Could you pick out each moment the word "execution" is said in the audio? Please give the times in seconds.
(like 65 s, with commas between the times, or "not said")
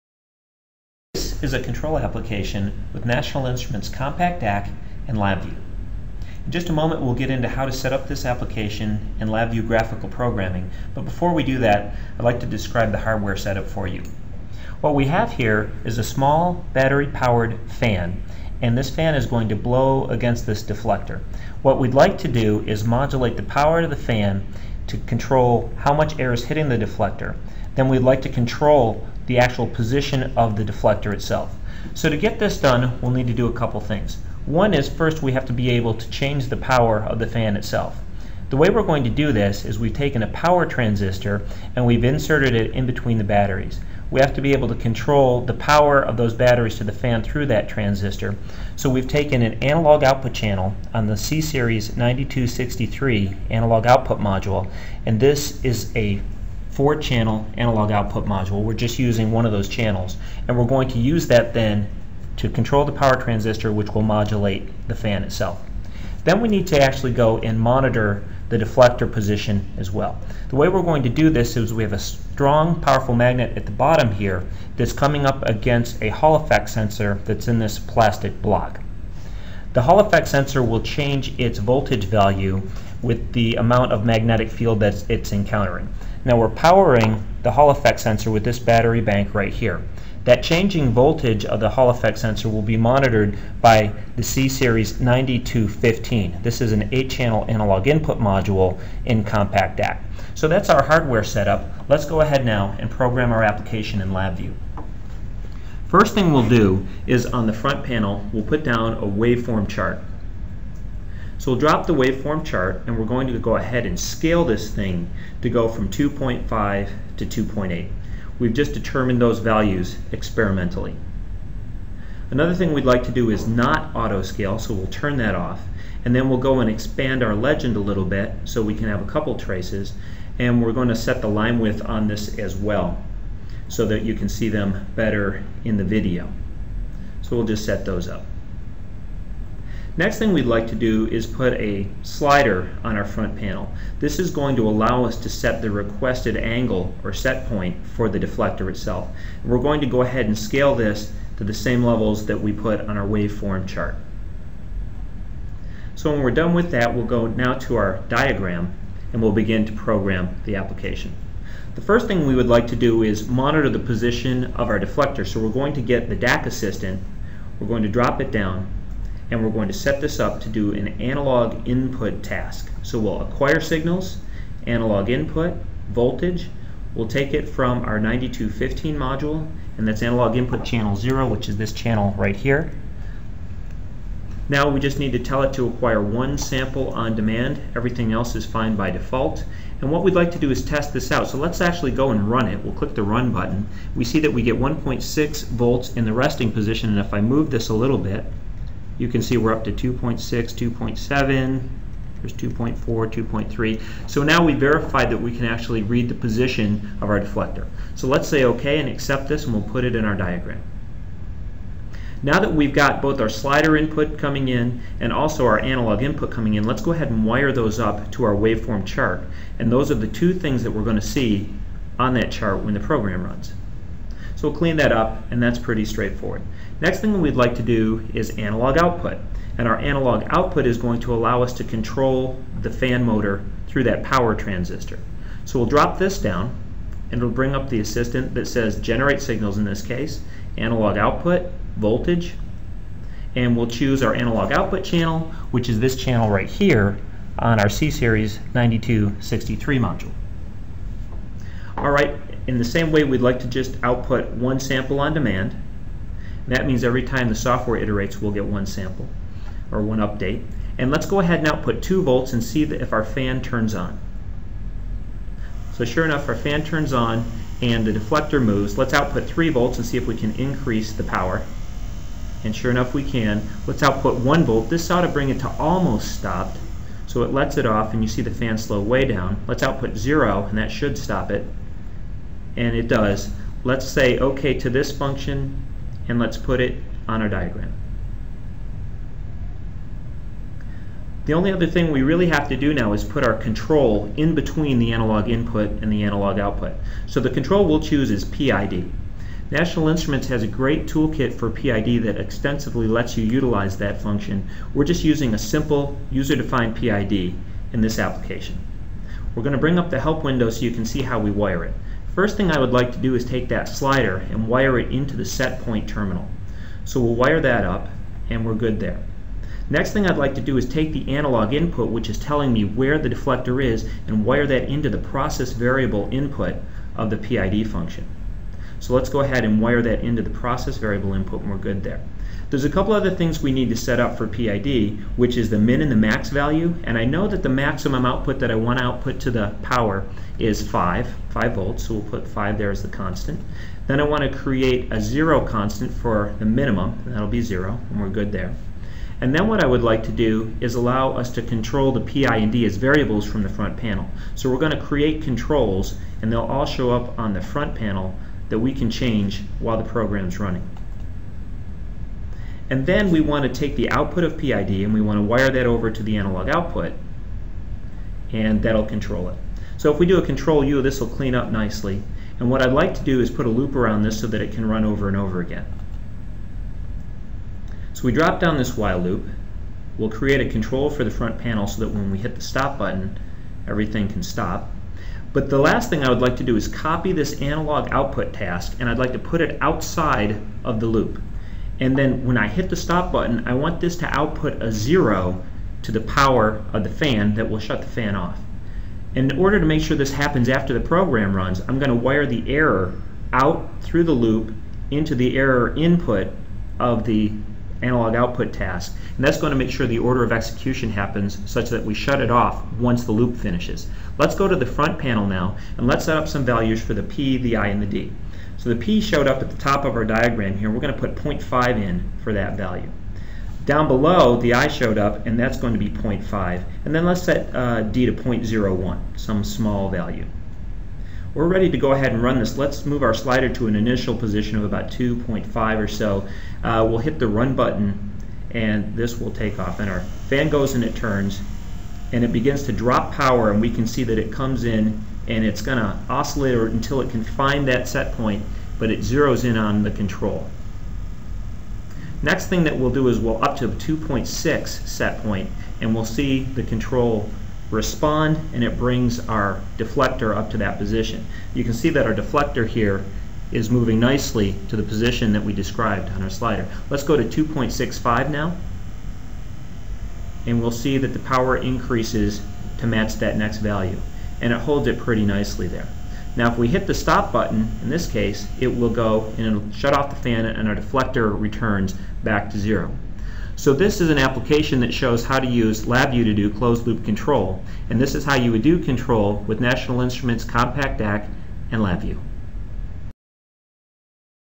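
410 s.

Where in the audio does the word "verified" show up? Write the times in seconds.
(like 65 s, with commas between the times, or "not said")
204 s.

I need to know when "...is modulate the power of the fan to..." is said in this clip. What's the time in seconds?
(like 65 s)
22 s.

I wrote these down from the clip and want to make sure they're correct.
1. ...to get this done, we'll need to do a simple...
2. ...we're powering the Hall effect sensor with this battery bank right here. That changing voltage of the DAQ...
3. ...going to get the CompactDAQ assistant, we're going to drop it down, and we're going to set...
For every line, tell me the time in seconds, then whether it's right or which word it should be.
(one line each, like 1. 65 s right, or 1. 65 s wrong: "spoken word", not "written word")
1. 32 s wrong: "couple", not "simple"
2. 86 s wrong: "Hall", not "DAQ"
3. 165 s wrong: "DAQ", not "CompactDAQ".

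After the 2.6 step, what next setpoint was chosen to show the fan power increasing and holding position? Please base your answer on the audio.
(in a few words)
2.65.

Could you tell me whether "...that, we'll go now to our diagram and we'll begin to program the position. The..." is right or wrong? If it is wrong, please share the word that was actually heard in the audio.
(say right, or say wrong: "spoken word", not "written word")
wrong: "application", not "position".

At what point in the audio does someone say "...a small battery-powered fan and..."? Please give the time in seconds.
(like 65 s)
15 s.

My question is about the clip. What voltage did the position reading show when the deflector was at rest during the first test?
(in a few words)
1.6 volts.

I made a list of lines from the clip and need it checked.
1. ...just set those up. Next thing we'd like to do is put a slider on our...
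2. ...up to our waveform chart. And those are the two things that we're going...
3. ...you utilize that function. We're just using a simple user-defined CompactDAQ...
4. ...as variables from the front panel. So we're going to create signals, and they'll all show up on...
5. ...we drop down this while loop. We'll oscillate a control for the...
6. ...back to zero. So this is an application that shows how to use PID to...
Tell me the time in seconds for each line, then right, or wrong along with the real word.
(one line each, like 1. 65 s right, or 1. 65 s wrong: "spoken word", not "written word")
1. 137 s right
2. 217 s right
3. 303 s wrong: "PID", not "CompactDAQ"
4. 352 s wrong: "controls", not "signals"
5. 378 s wrong: "create", not "oscillate"
6. 482 s wrong: "LabVIEW", not "PID".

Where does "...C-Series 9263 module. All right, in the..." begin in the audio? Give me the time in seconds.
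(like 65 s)
247 s.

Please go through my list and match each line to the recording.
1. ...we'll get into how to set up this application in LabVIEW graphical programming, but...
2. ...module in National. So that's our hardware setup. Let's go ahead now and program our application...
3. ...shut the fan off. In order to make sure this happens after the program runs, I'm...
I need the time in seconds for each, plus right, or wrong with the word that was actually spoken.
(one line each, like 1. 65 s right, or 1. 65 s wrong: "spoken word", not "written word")
1. 7 s right
2. 98 s wrong: "CompactDAQ", not "National"
3. 397 s right.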